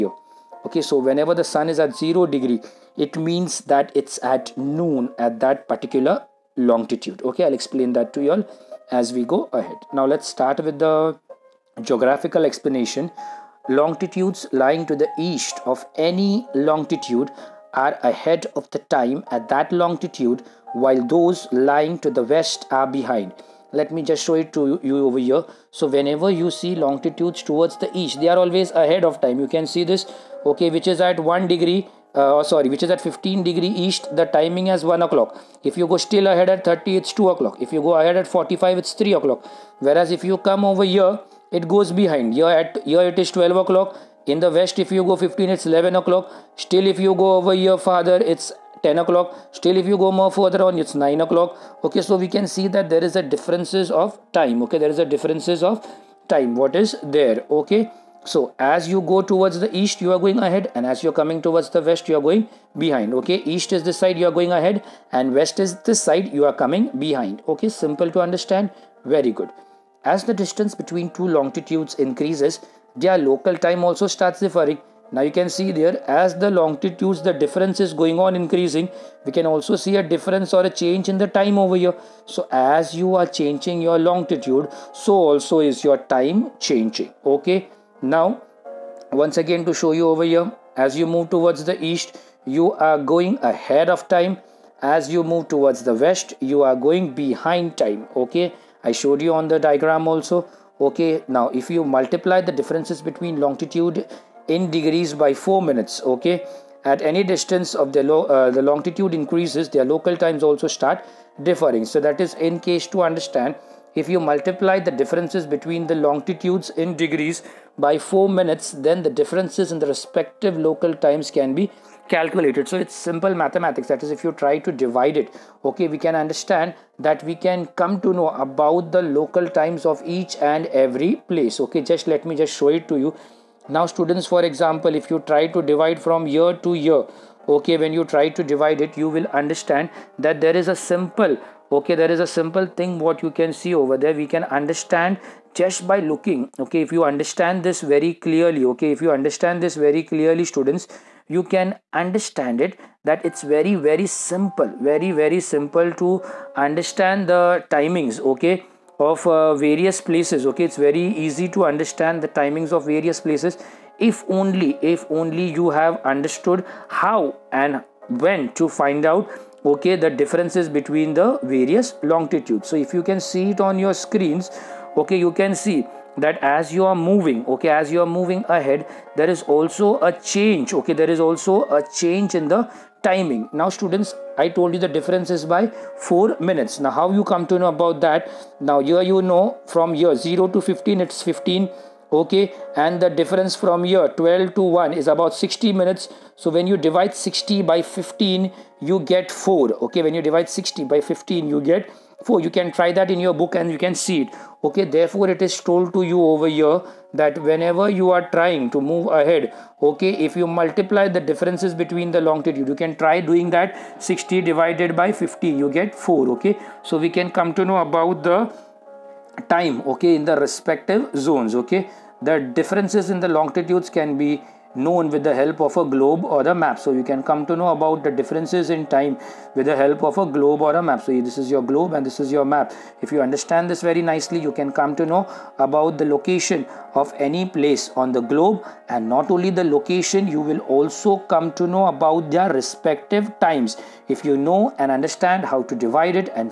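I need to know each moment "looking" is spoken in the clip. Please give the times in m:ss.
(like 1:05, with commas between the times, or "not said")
2:25.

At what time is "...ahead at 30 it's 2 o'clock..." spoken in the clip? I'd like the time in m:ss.
0:36.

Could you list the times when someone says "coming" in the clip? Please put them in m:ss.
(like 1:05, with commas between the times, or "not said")
1:01, 1:06.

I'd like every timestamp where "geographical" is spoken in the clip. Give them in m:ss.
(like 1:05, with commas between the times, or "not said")
0:11.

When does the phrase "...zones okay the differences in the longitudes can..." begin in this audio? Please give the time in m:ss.
3:41.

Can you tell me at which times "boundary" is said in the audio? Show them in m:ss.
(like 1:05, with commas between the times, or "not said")
not said.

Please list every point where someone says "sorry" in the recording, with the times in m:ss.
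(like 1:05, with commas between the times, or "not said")
0:32.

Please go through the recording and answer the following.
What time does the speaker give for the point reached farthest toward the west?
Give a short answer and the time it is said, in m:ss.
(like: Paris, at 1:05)
9 o'clock, at 0:50.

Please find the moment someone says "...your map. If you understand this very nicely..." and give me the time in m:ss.
3:52.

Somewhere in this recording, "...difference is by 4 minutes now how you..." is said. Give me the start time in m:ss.
3:04.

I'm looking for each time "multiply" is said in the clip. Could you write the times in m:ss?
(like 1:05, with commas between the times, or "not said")
1:41, 1:54, 3:30.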